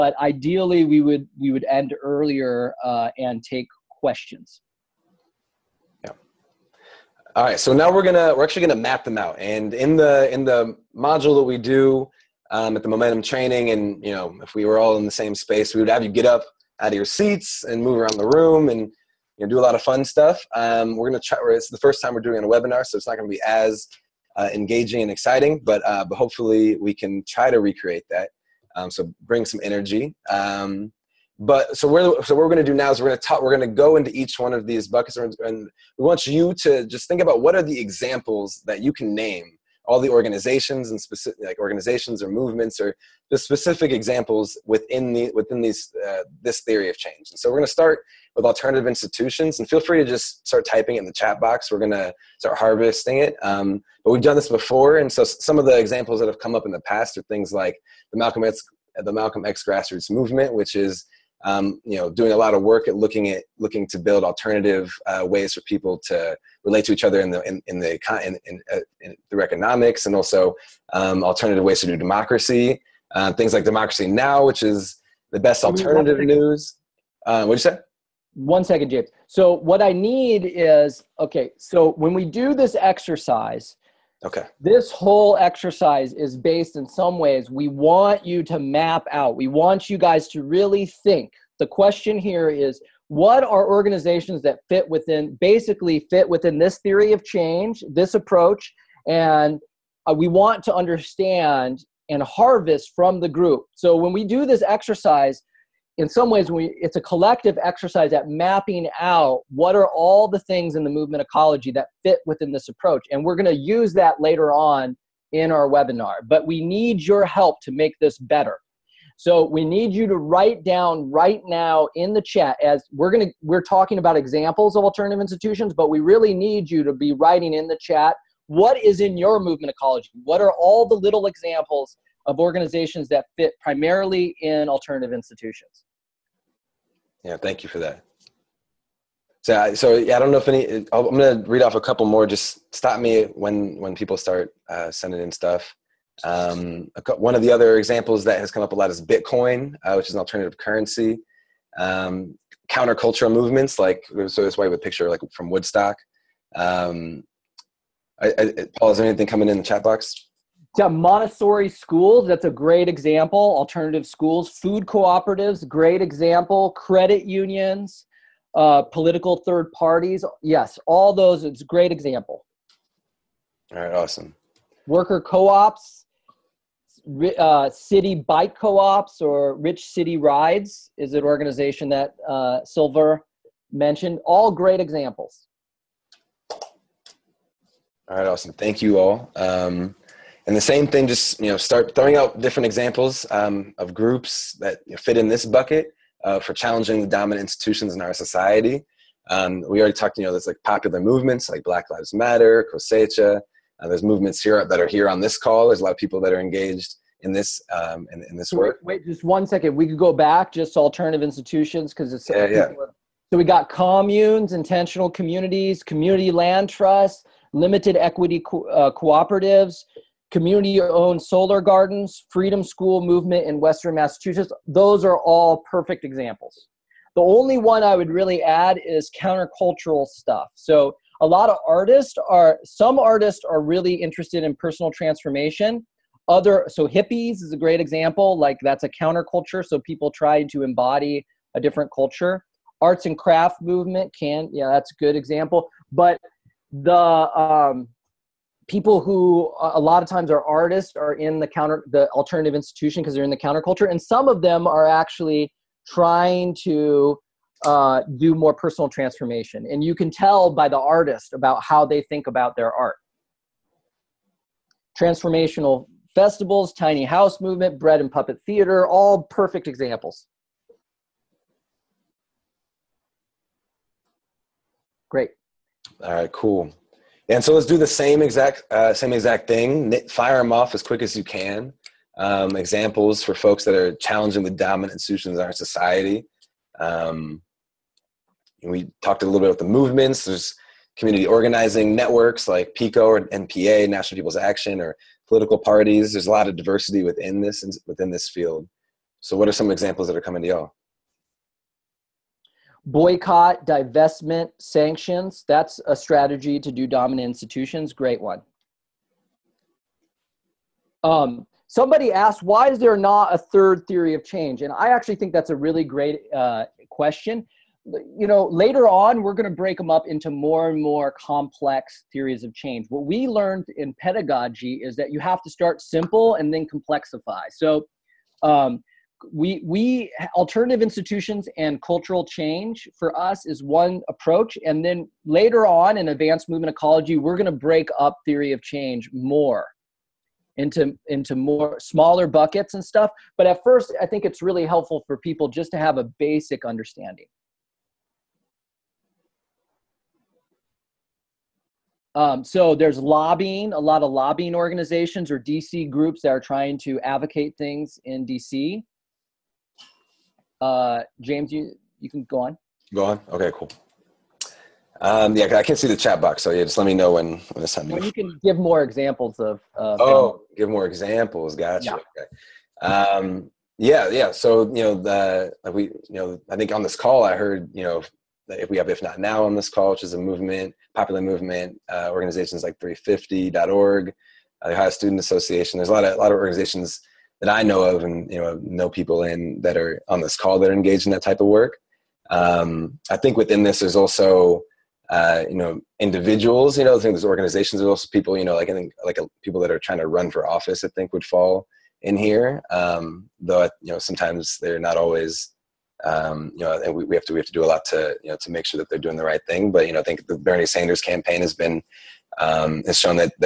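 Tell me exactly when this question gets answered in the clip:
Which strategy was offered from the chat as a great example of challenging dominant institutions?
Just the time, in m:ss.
5:02.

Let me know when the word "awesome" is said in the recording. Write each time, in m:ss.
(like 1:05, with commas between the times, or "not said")
2:53, 3:08.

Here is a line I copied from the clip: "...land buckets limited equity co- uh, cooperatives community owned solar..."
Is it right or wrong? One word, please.
wrong.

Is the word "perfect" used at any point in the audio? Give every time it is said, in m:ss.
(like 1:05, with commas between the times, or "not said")
3:45, 4:29.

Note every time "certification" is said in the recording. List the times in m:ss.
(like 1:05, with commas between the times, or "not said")
not said.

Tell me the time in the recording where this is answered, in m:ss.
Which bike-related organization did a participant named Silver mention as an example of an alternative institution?
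2:59.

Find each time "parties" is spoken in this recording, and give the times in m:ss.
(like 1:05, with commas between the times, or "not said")
2:49, 4:55.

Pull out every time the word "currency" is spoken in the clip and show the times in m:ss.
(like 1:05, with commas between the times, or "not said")
2:30.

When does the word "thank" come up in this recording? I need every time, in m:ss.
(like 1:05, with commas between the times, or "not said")
2:17, 3:08.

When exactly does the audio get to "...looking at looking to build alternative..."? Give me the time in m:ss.
1:02.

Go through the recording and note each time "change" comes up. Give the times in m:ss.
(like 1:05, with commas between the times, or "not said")
0:46, 1:37, 5:14, 5:22, 5:32, 5:38.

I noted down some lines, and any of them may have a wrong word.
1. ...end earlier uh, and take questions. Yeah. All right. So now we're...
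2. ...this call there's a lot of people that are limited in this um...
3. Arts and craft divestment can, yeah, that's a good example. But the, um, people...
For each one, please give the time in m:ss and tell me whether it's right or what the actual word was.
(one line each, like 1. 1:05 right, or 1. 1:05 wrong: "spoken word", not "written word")
1. 0:01 right
2. 3:25 wrong: "engaged", not "limited"
3. 4:02 wrong: "movement", not "divestment".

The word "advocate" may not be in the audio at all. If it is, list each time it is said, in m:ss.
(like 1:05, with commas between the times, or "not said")
5:57.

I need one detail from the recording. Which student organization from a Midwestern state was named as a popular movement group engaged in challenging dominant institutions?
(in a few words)
Ohio Student Association.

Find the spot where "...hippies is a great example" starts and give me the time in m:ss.
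3:56.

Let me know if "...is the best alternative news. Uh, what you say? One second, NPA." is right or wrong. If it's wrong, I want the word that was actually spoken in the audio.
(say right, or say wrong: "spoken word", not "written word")
wrong: "James", not "NPA".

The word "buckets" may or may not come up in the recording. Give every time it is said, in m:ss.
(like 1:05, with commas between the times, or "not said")
0:34, 3:15, 5:42.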